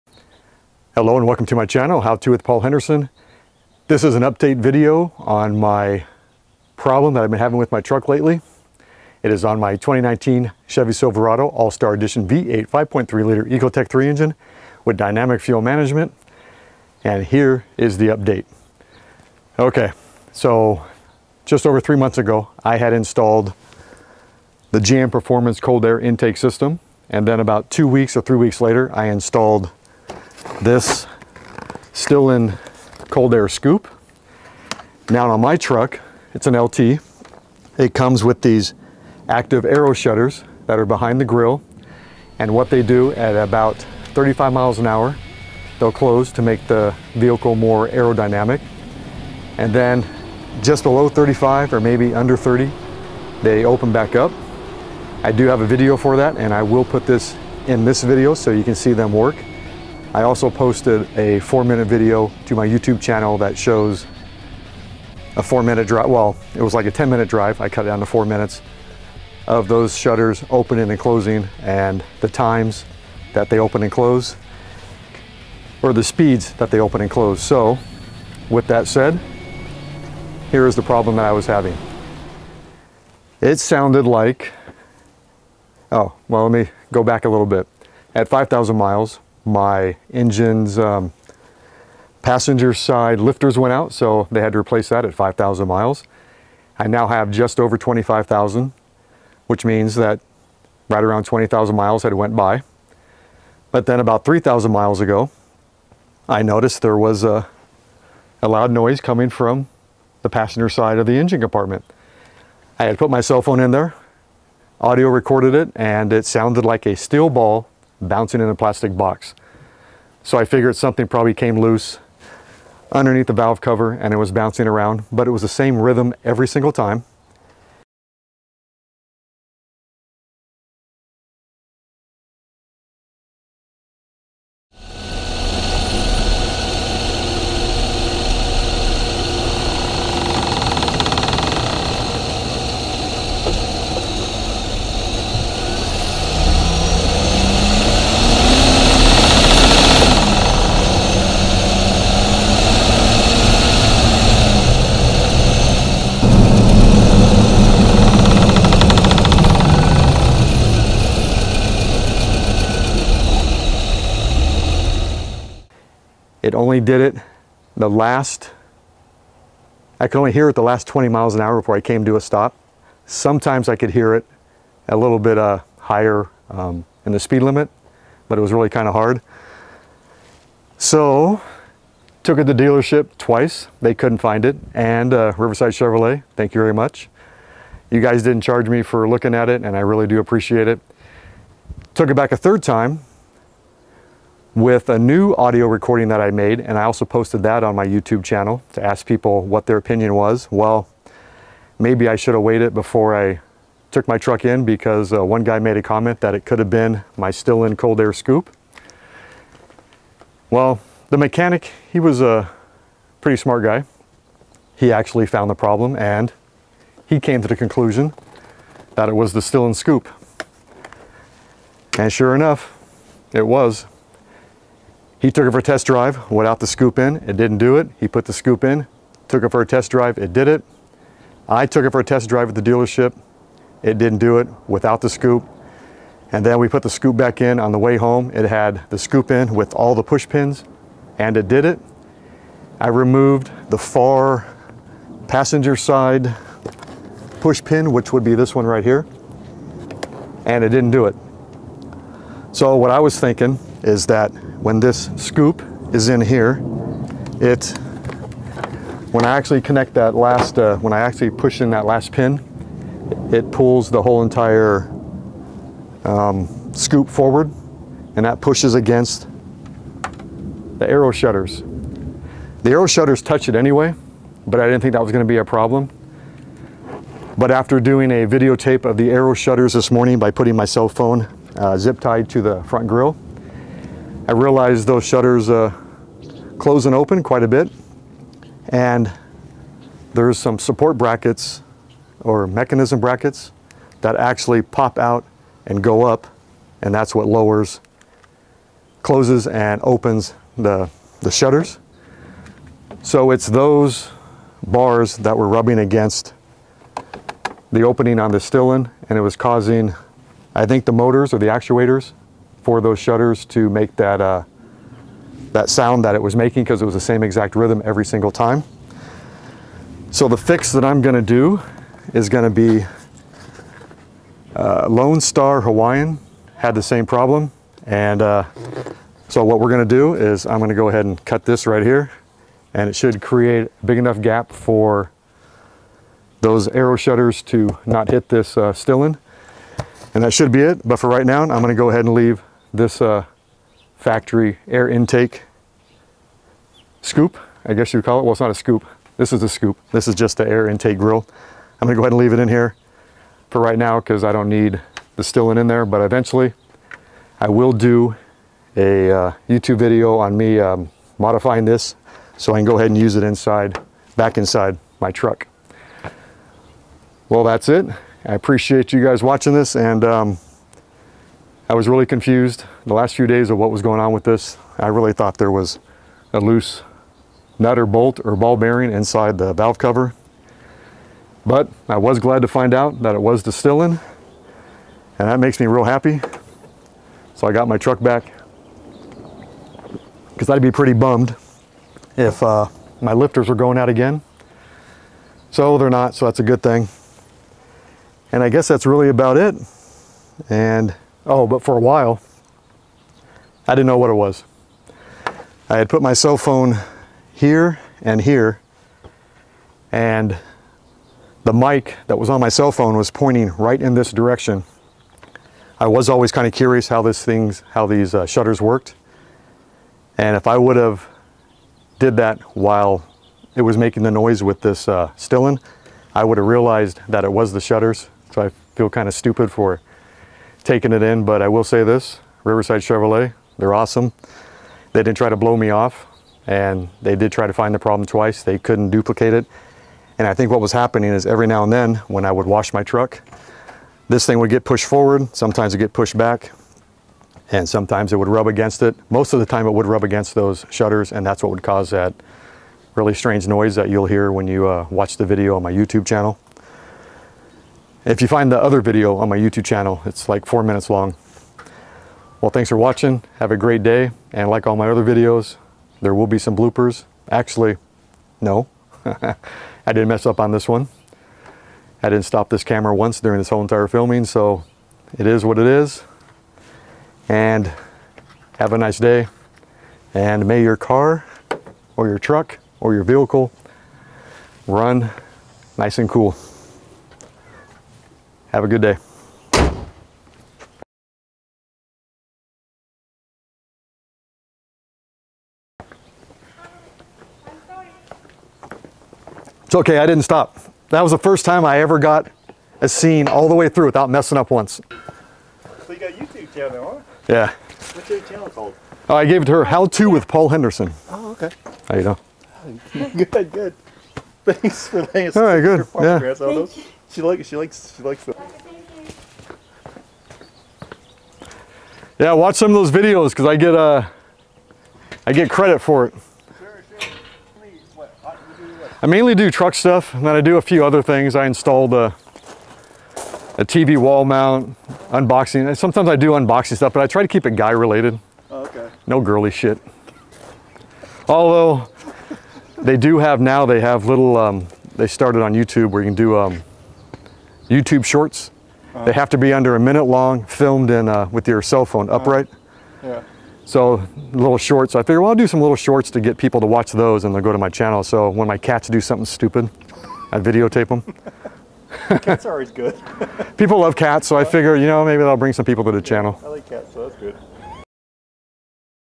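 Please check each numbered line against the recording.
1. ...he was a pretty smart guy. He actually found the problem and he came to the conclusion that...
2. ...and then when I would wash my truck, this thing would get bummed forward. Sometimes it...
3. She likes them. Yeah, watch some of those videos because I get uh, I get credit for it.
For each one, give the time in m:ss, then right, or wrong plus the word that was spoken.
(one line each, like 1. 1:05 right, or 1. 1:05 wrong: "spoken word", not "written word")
1. 3:31 right
2. 7:21 wrong: "pushed", not "bummed"
3. 8:37 right.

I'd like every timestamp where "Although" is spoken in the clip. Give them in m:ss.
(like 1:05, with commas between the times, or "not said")
9:01.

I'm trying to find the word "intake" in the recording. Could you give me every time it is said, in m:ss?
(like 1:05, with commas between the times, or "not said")
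0:26, 5:44, 5:50.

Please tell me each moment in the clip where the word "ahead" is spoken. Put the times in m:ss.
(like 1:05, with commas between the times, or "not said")
5:30, 5:41, 5:52, 6:02.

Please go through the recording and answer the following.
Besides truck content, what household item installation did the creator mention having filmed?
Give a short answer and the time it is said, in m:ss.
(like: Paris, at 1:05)
TV wall mount, at 8:53.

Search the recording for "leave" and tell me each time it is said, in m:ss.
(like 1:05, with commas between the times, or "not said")
5:42, 5:52.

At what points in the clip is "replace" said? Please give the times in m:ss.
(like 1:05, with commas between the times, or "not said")
1:34.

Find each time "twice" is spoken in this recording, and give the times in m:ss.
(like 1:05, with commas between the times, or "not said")
3:03, 7:18.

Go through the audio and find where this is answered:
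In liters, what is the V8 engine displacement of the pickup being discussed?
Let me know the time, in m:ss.
0:12.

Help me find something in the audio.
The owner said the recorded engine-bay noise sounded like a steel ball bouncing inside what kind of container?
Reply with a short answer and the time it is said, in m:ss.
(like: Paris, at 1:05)
plastic box, at 1:58.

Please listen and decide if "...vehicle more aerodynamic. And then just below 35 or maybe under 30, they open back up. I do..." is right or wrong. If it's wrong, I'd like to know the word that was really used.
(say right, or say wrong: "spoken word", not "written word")
right.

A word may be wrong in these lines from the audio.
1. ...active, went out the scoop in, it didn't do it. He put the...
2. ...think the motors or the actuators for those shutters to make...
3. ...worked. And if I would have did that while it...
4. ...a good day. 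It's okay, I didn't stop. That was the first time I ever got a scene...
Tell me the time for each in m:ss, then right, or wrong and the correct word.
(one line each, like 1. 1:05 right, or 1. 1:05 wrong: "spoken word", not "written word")
1. 3:45 wrong: "drive", not "active"
2. 5:10 right
3. 6:58 right
4. 8:08 right.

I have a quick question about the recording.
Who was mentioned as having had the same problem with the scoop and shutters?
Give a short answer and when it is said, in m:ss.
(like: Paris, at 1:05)
Lone Star Hawaiian, at 5:24.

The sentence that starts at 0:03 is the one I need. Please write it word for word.
This is an update video on my problem that I've been having with my truck lately.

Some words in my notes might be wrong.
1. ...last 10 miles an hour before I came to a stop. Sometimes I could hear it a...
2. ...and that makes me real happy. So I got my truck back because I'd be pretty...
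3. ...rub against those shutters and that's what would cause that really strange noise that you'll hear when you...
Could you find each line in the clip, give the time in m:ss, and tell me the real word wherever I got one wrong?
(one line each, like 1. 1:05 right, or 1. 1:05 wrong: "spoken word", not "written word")
1. 2:50 wrong: "20", not "10"
2. 6:25 right
3. 7:29 right.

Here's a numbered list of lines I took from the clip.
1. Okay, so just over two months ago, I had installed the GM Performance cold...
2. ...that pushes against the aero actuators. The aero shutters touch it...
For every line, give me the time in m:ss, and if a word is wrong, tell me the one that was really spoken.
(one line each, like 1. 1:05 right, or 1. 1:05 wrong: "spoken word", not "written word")
1. 0:19 wrong: "three", not "two"
2. 4:28 wrong: "shutters", not "actuators".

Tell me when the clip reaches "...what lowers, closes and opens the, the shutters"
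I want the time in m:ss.
4:57.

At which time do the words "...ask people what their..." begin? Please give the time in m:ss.
3:18.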